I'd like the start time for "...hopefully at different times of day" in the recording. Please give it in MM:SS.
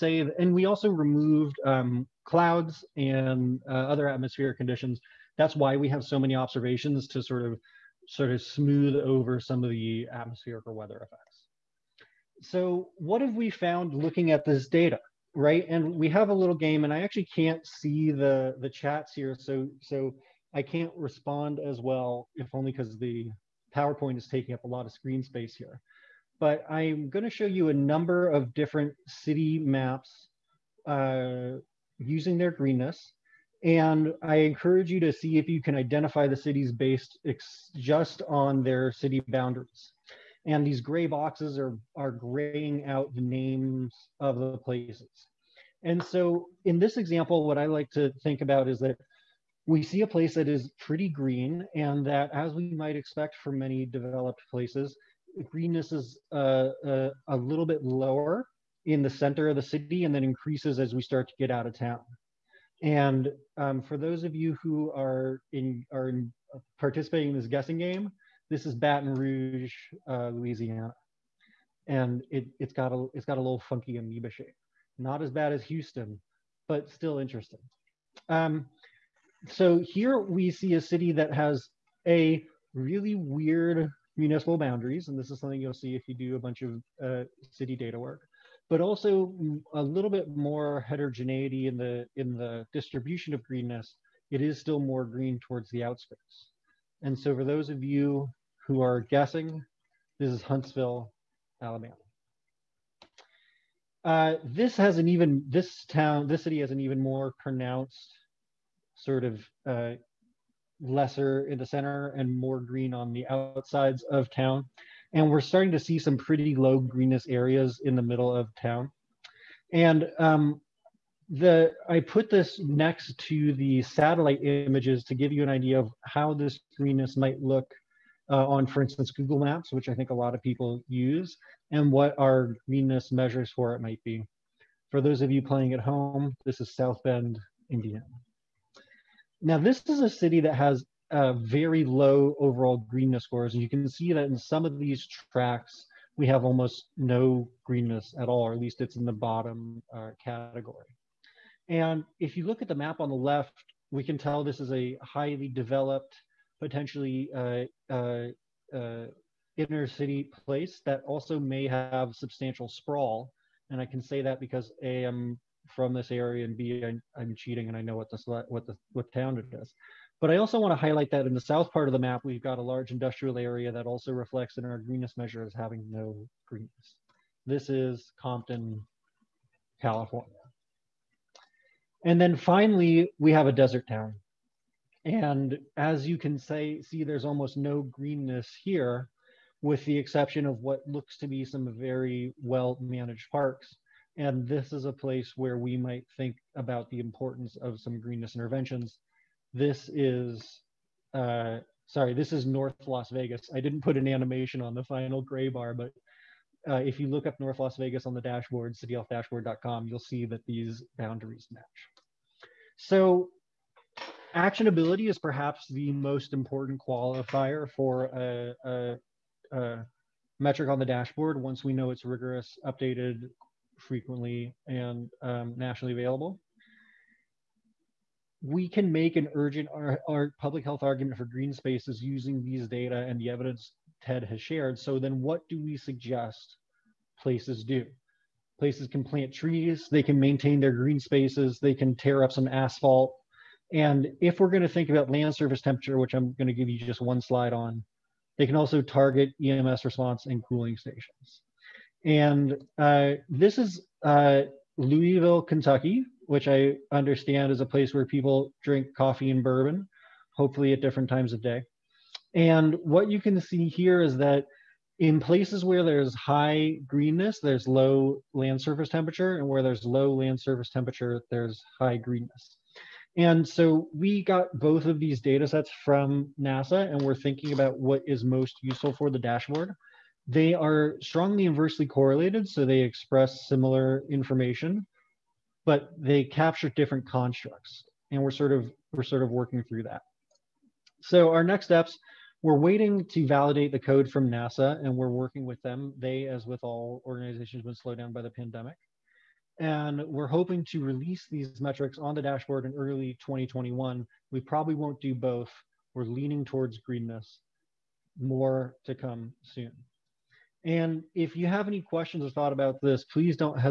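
04:20.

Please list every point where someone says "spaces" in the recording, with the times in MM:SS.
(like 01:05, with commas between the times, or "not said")
00:25, 03:51, 04:00.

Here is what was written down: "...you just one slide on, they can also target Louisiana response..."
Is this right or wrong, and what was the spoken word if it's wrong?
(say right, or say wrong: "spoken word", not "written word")
wrong: "EMS", not "Louisiana".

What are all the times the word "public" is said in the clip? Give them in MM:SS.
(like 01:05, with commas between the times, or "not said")
03:50.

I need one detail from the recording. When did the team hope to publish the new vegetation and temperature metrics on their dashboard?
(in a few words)
early 2021.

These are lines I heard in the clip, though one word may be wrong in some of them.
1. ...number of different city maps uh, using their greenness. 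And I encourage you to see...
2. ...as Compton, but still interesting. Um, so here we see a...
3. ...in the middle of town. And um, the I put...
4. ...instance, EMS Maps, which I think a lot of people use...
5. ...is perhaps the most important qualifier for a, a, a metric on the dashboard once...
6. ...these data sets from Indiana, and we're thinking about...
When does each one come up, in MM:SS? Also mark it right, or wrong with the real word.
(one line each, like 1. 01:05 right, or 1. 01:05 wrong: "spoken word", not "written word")
1. 00:27 right
2. 01:15 wrong: "Houston", not "Compton"
3. 01:57 right
4. 02:08 wrong: "Google", not "EMS"
5. 03:35 right
6. 04:34 wrong: "NASA", not "Indiana".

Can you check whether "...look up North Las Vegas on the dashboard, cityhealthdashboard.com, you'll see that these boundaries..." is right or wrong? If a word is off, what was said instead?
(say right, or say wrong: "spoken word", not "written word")
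right.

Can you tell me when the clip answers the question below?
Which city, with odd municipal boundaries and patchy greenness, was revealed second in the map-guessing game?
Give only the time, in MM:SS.
01:40.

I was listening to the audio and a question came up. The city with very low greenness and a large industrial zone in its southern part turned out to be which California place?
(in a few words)
Compton.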